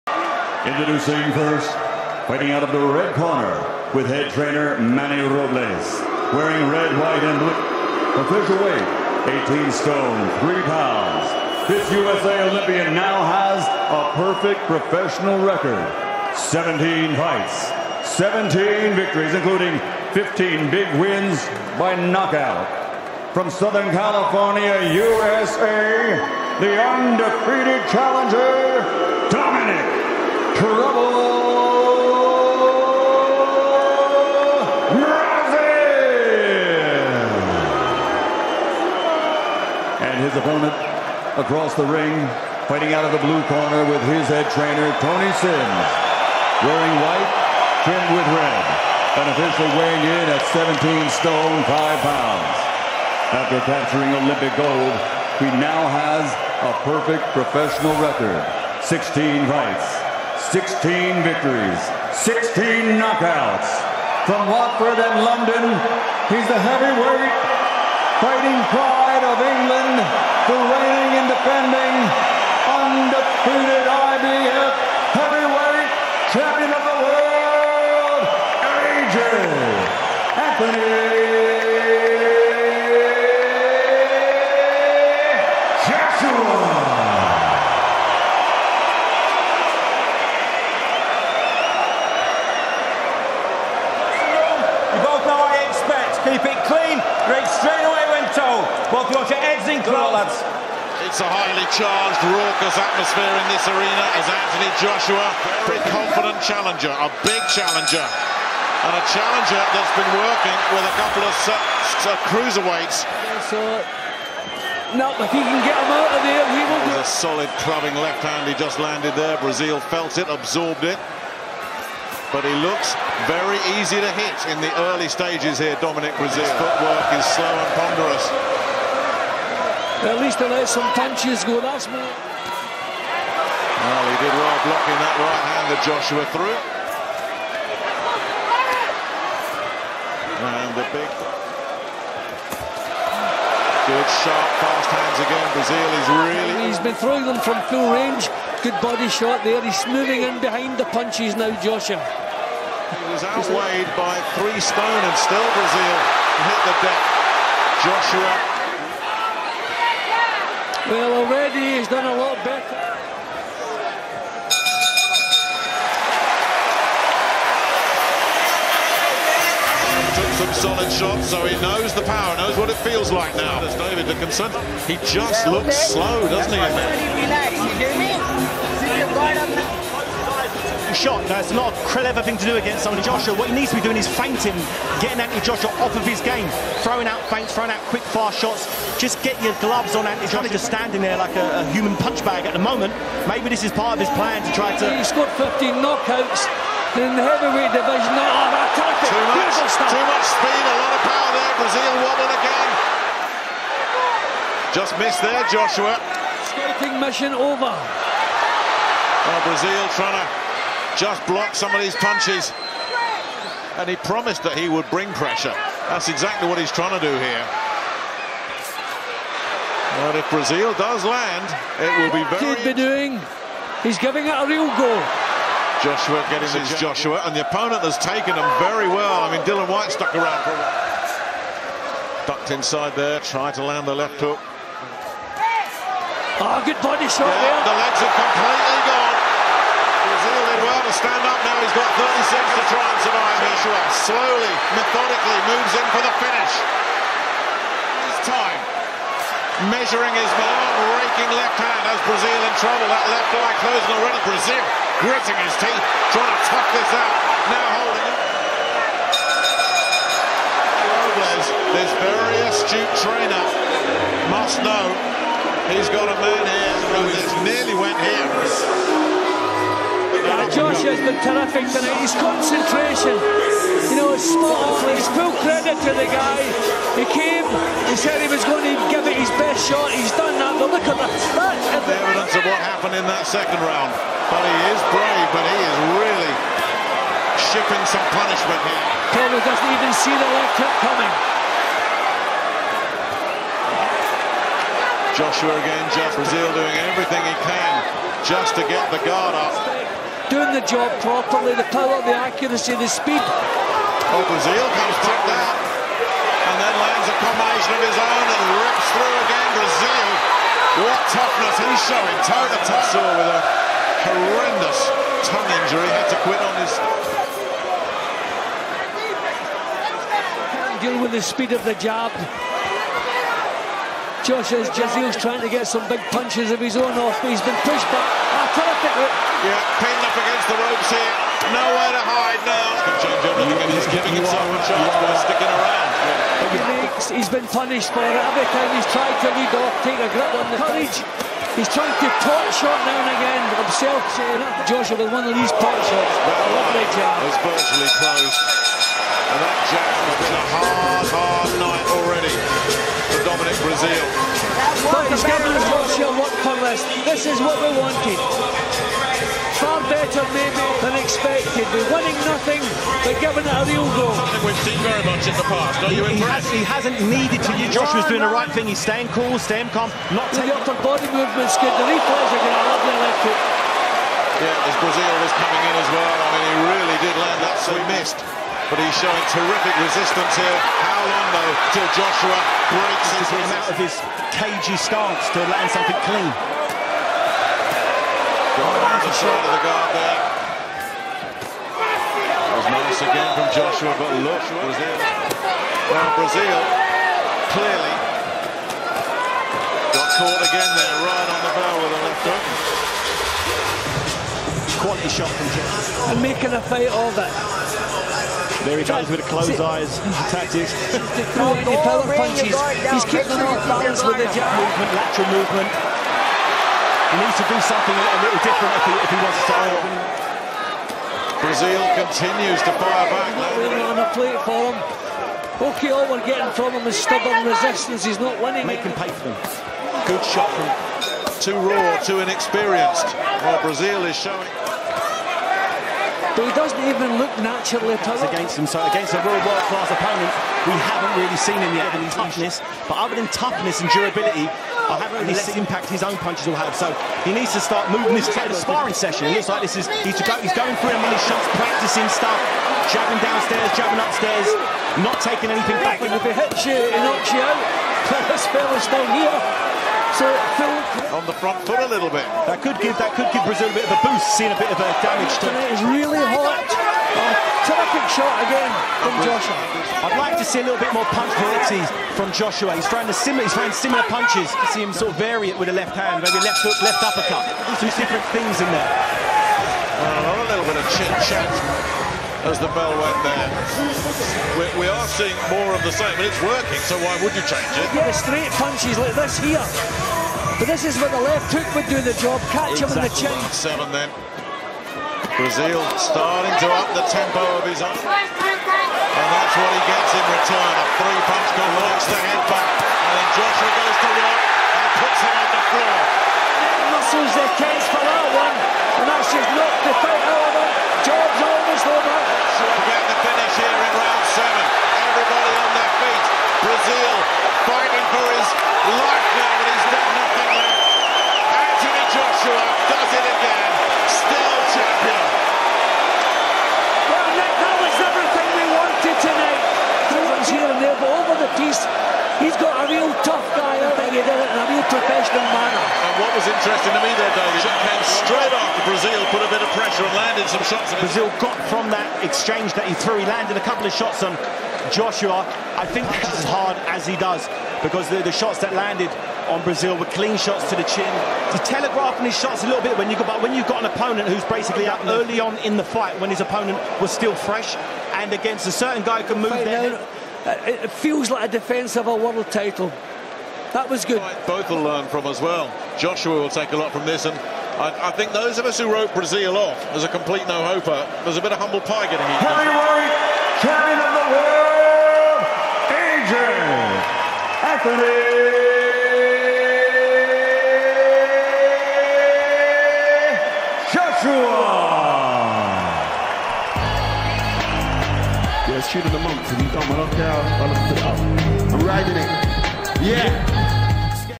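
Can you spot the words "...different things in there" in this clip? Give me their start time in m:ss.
7:57.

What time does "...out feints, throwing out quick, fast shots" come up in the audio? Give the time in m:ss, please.
3:07.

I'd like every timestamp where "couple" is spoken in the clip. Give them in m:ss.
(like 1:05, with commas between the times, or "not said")
1:51, 9:03.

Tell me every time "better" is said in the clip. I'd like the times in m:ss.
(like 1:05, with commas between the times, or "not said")
2:42, 5:59.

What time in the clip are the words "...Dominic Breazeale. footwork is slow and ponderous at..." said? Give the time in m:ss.
2:05.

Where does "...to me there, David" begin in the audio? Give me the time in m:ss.
8:56.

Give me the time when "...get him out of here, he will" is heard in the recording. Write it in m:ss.
1:55.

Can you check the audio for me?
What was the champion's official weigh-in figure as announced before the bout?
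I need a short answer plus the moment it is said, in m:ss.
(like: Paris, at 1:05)
17 stone 5 pounds, at 0:50.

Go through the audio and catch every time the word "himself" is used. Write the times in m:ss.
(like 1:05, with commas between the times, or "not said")
5:34, 5:43.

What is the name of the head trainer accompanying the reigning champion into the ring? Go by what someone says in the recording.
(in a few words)
Tony Sims.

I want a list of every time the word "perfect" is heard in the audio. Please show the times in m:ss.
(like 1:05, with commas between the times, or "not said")
0:14, 0:56.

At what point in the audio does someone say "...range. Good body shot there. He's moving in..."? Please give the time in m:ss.
2:27.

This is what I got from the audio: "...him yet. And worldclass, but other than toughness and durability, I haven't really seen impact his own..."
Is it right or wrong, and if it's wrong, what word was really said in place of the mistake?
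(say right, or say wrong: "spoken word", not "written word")
wrong: "toughness", not "worldclass".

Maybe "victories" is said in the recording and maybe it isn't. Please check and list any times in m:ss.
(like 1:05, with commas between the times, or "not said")
0:18, 1:01.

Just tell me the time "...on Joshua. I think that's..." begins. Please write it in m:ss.
9:04.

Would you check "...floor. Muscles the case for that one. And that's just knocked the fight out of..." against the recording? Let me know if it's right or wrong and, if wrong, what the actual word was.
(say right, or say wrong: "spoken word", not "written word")
right.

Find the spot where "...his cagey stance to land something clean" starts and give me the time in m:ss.
6:23.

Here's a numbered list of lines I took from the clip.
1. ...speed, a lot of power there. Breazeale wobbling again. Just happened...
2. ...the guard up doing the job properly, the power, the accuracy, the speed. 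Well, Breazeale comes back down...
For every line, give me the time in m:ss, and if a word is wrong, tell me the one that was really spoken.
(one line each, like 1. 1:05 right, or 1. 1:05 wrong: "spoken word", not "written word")
1. 3:20 wrong: "missed", not "happened"
2. 4:58 right.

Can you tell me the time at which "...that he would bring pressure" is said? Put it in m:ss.
3:34.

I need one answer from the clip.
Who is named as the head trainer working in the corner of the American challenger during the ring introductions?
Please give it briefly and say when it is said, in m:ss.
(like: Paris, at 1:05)
Manny Robles, at 0:04.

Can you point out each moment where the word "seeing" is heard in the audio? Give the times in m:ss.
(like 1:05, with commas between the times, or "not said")
7:44, 8:05.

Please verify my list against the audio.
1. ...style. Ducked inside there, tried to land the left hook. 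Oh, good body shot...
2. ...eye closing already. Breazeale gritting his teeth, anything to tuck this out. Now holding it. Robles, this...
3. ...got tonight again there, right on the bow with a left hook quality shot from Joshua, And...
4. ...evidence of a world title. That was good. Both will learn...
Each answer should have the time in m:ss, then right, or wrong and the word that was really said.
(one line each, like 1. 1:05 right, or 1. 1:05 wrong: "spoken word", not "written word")
1. 3:50 wrong: "while", not "style"
2. 4:13 wrong: "trying", not "anything"
3. 6:39 wrong: "caught", not "tonight"
4. 9:21 wrong: "defence", not "evidence".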